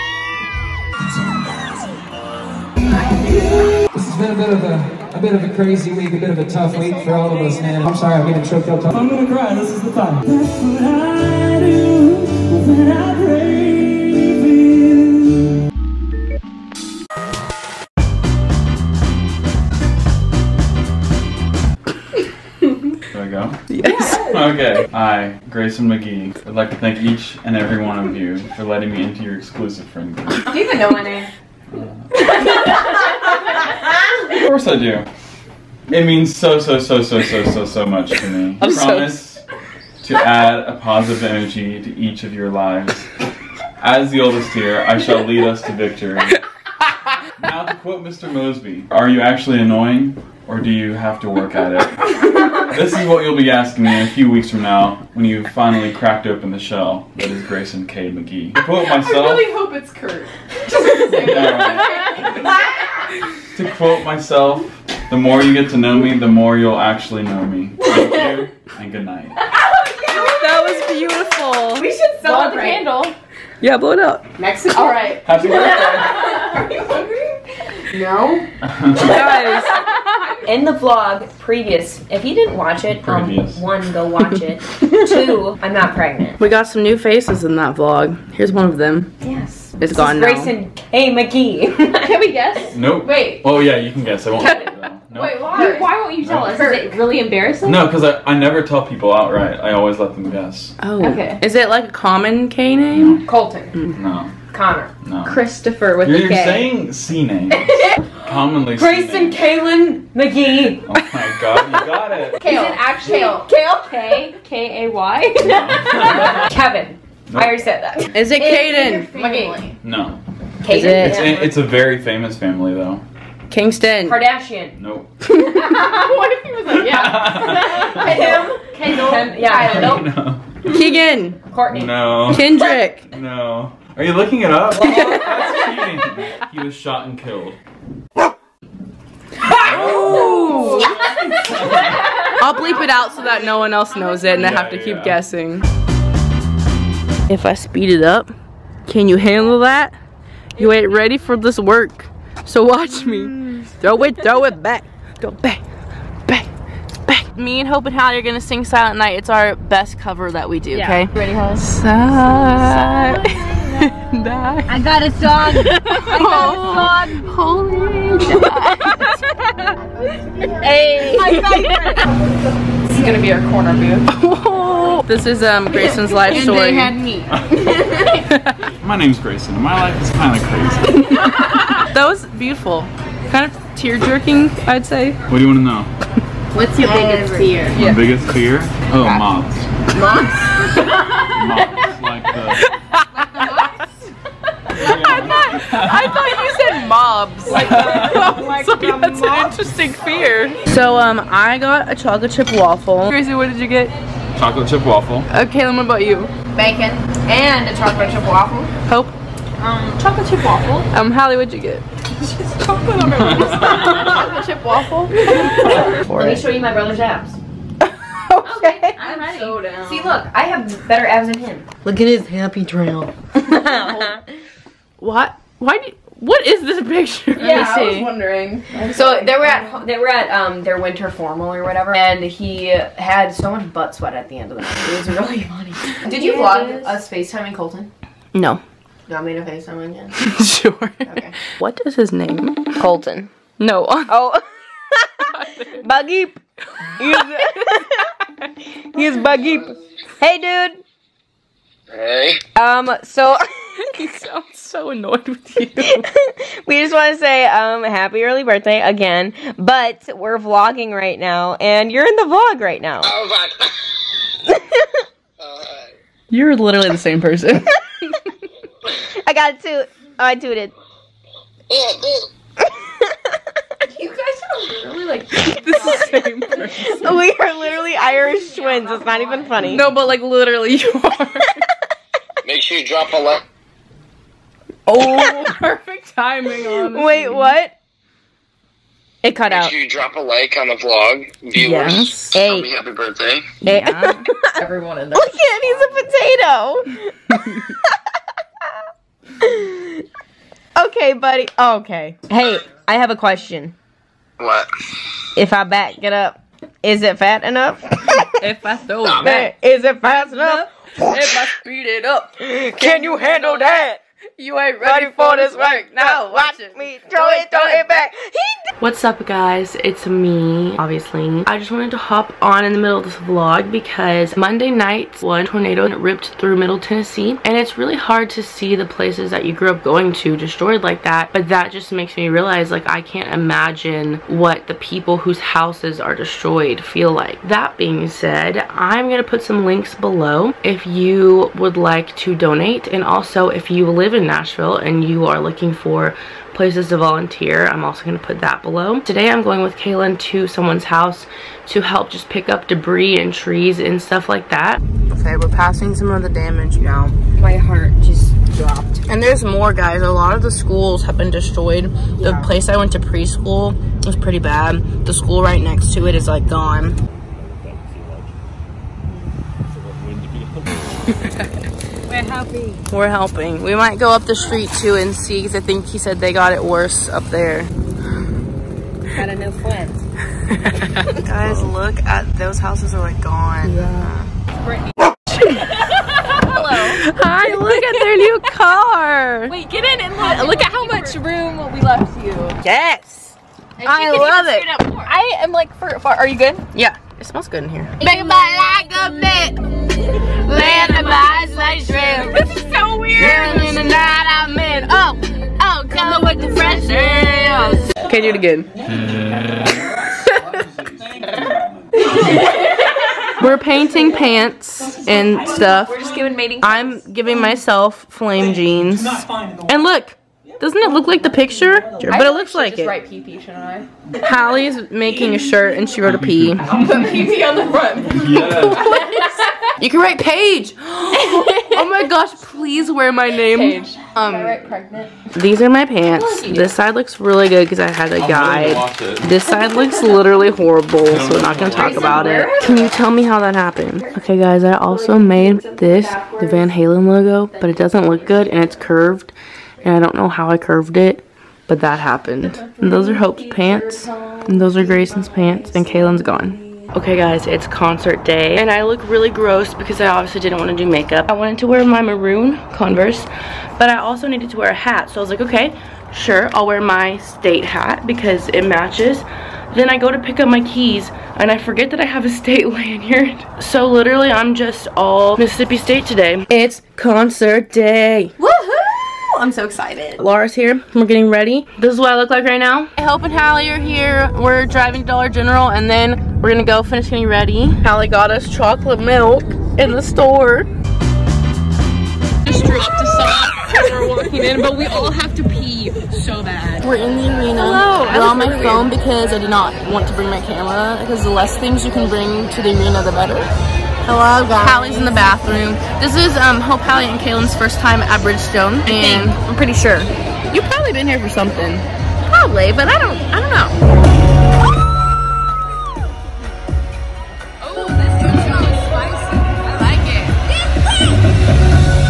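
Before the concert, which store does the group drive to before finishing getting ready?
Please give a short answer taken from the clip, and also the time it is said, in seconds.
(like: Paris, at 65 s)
Dollar General, at 485 s.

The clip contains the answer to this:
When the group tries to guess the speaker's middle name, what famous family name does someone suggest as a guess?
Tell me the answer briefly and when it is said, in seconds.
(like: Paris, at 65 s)
Kardashian, at 124 s.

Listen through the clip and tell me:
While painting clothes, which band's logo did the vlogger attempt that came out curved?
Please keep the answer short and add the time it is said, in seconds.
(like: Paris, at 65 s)
Van Halen, at 446 s.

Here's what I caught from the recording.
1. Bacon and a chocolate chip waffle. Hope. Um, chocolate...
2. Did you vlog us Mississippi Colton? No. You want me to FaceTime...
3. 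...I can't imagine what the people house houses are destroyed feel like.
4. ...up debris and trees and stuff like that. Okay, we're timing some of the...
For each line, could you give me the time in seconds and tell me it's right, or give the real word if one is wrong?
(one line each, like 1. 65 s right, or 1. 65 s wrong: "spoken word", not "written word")
1. 206 s right
2. 236 s wrong: "FaceTiming", not "Mississippi"
3. 332 s wrong: "whose", not "house"
4. 352 s wrong: "passing", not "timing".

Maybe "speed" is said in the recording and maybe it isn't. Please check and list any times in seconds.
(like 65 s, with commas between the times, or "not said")
147 s, 311 s.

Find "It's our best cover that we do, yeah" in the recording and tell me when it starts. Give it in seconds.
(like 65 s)
159 s.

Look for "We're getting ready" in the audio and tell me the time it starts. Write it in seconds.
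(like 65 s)
480 s.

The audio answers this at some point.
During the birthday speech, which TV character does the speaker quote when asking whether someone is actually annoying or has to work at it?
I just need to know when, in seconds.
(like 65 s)
48 s.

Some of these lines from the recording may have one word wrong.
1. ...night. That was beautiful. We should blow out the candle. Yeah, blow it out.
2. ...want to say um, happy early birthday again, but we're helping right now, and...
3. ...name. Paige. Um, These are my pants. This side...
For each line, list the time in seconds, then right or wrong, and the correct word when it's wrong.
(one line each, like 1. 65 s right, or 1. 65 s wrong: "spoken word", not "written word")
1. 69 s right
2. 256 s wrong: "vlogging", not "helping"
3. 433 s right.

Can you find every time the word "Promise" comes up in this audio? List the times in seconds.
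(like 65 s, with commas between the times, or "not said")
38 s.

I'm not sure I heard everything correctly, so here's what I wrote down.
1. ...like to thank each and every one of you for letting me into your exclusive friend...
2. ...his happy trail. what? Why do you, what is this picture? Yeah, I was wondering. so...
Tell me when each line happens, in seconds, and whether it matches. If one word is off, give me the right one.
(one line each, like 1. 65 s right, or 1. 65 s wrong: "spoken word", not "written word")
1. 26 s right
2. 222 s right.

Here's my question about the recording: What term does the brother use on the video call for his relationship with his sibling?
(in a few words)
Irish twins.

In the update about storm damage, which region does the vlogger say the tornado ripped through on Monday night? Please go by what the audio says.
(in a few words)
Middle Tennessee.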